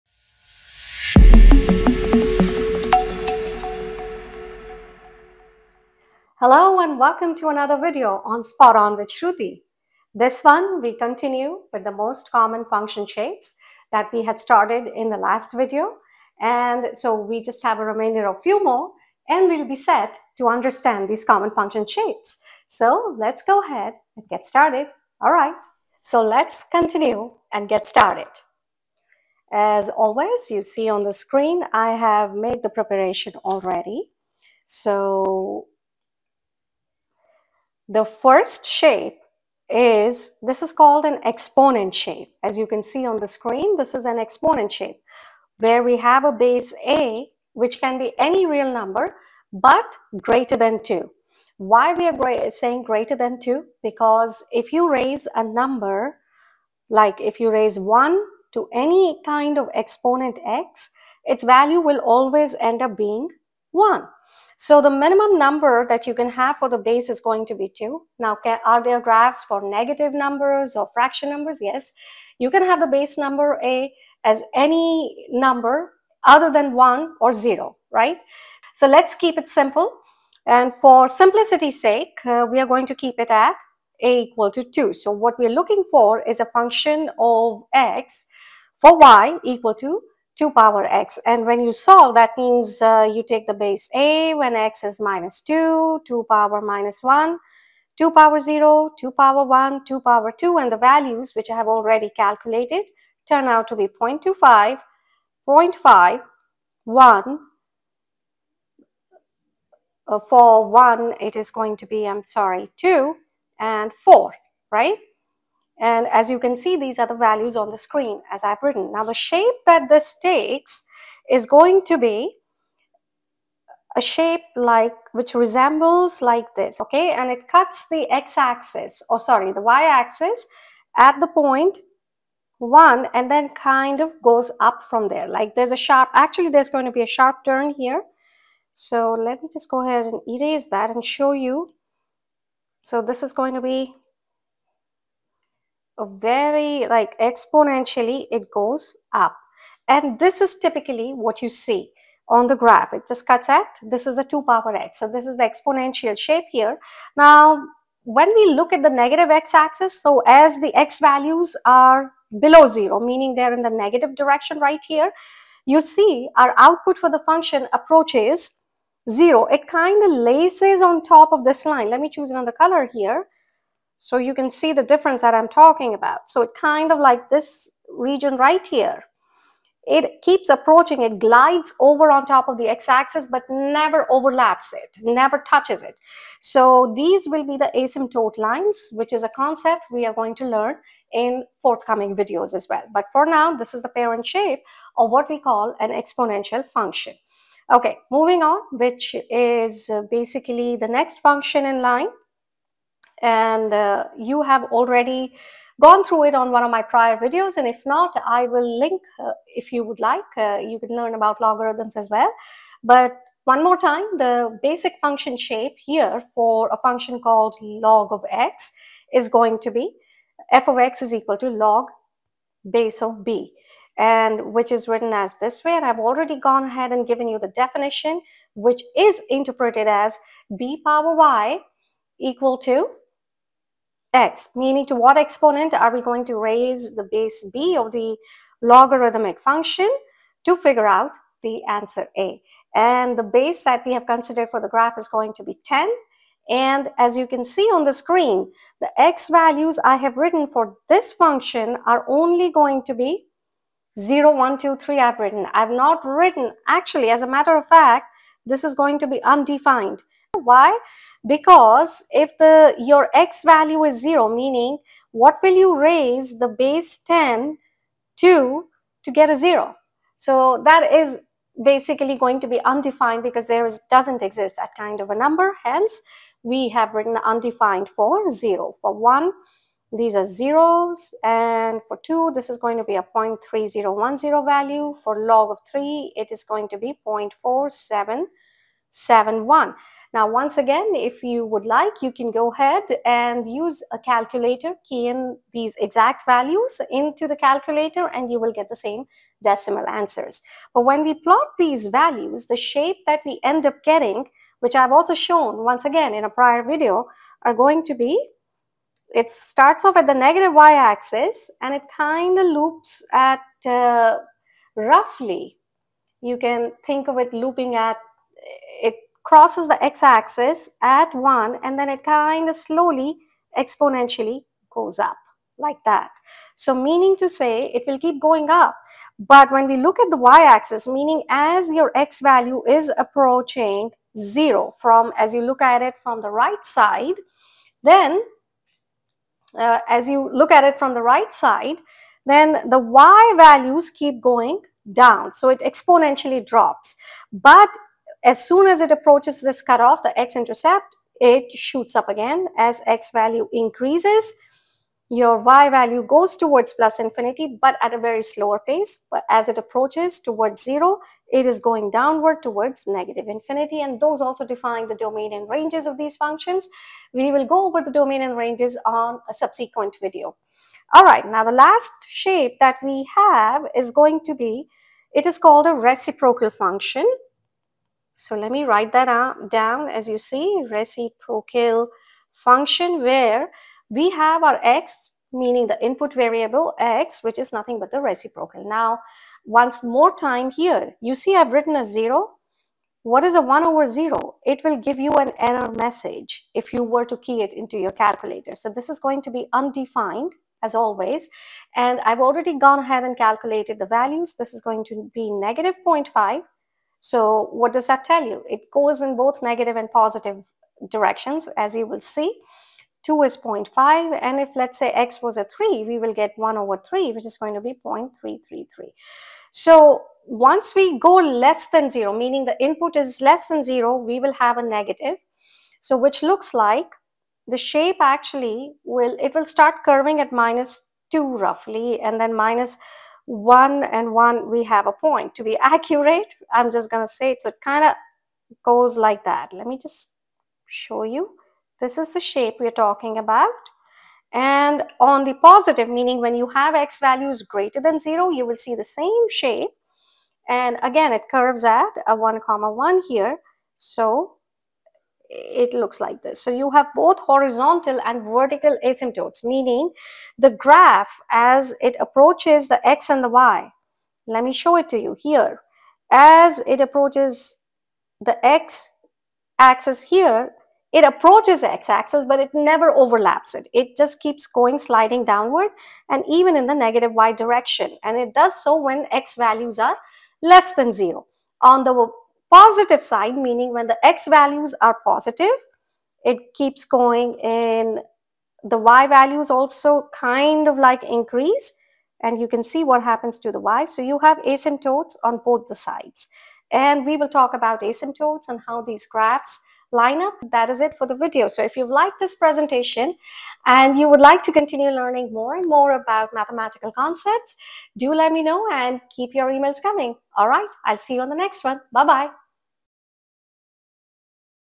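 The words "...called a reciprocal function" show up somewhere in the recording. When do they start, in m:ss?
6:15.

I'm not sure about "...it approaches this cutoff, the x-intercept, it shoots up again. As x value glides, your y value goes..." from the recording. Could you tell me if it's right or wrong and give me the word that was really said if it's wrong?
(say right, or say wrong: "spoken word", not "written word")
wrong: "increases", not "glides".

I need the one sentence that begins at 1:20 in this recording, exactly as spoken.
And for simplicity's sake, uh, we are going to keep it at a equal to 2.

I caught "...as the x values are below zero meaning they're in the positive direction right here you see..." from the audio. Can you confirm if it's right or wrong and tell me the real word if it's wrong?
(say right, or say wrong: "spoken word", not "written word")
wrong: "negative", not "positive".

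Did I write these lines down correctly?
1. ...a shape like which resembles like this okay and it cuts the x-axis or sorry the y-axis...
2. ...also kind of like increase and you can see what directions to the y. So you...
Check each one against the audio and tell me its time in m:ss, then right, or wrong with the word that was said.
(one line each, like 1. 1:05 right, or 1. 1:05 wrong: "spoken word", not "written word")
1. 2:03 right
2. 8:09 wrong: "happens", not "directions".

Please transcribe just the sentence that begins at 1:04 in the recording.
So the minimum number that you can have for the base is going to be 2.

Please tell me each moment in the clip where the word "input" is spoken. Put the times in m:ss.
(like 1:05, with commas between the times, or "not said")
6:25, 7:02.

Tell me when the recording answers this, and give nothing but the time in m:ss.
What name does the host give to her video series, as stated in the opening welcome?
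0:08.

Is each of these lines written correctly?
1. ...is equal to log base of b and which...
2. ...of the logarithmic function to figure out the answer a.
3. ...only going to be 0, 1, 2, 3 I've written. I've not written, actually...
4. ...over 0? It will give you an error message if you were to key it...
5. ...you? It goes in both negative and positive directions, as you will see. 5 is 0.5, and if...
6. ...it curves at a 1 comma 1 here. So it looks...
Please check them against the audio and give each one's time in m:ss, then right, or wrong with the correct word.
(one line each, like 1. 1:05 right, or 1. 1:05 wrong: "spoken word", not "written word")
1. 3:41 right
2. 3:57 right
3. 4:12 right
4. 6:33 right
5. 6:48 wrong: "2", not "5"
6. 7:31 right.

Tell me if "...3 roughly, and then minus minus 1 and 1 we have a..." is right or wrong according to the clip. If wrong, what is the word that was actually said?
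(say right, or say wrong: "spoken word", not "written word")
wrong: "2", not "3".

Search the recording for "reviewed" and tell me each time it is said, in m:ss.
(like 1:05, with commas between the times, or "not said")
not said.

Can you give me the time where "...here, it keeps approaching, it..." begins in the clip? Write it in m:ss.
2:58.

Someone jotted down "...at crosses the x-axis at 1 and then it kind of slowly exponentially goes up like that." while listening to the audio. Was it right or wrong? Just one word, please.
right.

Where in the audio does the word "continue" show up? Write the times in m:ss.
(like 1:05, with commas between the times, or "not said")
0:10, 0:26, 8:24.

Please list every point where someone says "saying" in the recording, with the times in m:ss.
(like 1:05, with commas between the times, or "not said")
0:52.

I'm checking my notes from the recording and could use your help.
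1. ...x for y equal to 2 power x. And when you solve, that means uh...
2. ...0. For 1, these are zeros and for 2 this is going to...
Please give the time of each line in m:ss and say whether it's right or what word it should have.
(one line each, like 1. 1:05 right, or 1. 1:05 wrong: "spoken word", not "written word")
1. 1:27 right
2. 4:38 right.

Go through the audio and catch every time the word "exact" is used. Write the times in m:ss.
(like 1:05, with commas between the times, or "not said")
4:55.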